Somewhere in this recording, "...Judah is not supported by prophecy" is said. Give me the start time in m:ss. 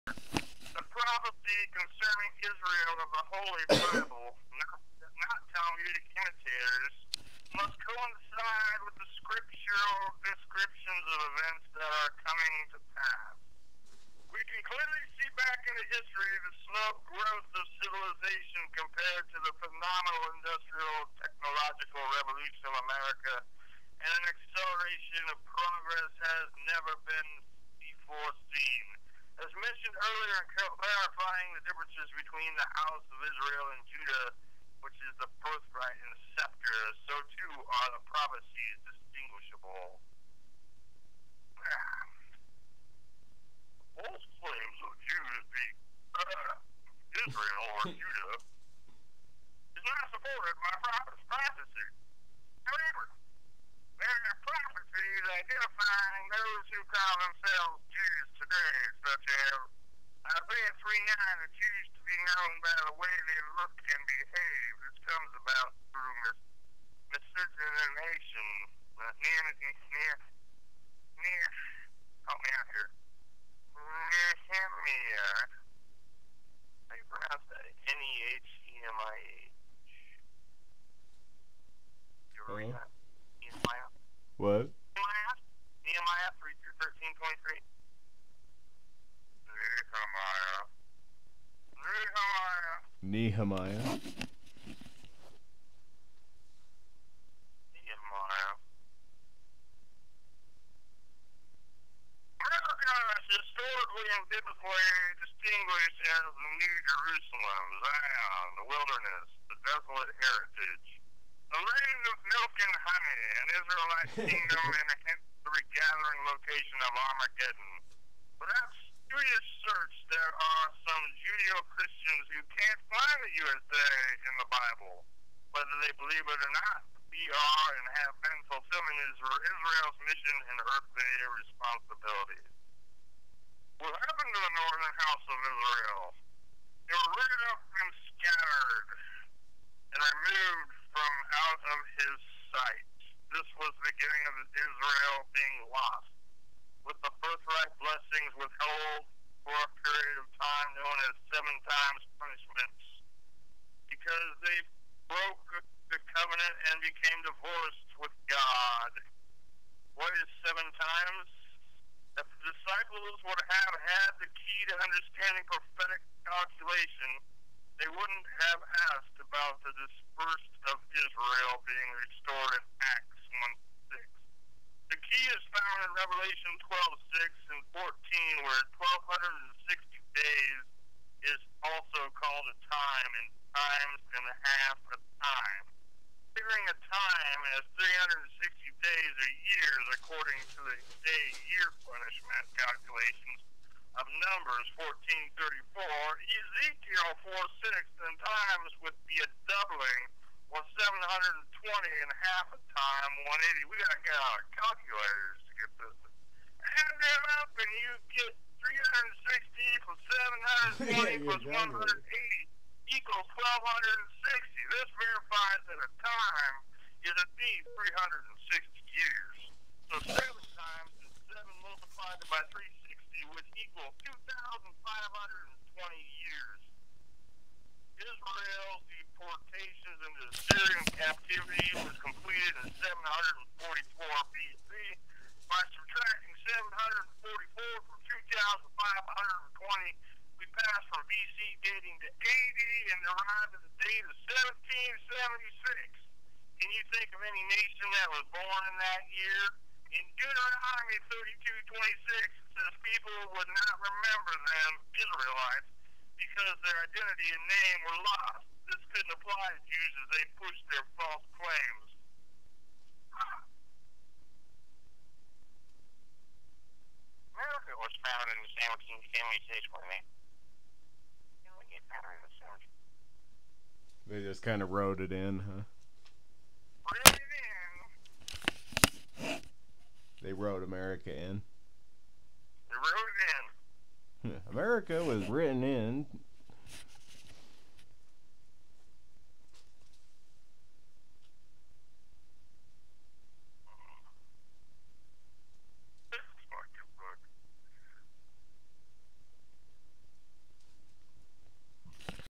0:47.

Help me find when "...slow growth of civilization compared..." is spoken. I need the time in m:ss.
0:16.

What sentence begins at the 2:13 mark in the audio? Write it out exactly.
What happened to the northern house of Israel?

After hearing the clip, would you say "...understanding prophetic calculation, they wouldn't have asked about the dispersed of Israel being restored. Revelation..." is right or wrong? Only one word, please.
right.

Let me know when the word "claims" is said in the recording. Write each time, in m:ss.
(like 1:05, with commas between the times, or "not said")
0:44, 4:21.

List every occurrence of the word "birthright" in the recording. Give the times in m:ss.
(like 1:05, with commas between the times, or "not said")
0:35, 2:27.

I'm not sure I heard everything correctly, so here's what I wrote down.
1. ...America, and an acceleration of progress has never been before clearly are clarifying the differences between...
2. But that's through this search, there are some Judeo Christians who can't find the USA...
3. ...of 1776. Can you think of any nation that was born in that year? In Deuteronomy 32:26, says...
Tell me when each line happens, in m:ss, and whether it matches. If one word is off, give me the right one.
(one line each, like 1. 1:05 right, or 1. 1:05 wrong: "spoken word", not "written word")
1. 0:22 right
2. 1:58 right
3. 4:04 right.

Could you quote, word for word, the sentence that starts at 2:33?
Because they broke the covenant and became divorced with God.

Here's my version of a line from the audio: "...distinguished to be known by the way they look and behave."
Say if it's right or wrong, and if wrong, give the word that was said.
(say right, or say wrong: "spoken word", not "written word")
wrong: "accused", not "distinguished".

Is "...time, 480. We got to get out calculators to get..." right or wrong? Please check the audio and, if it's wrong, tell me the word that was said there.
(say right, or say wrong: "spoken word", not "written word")
wrong: "180", not "480".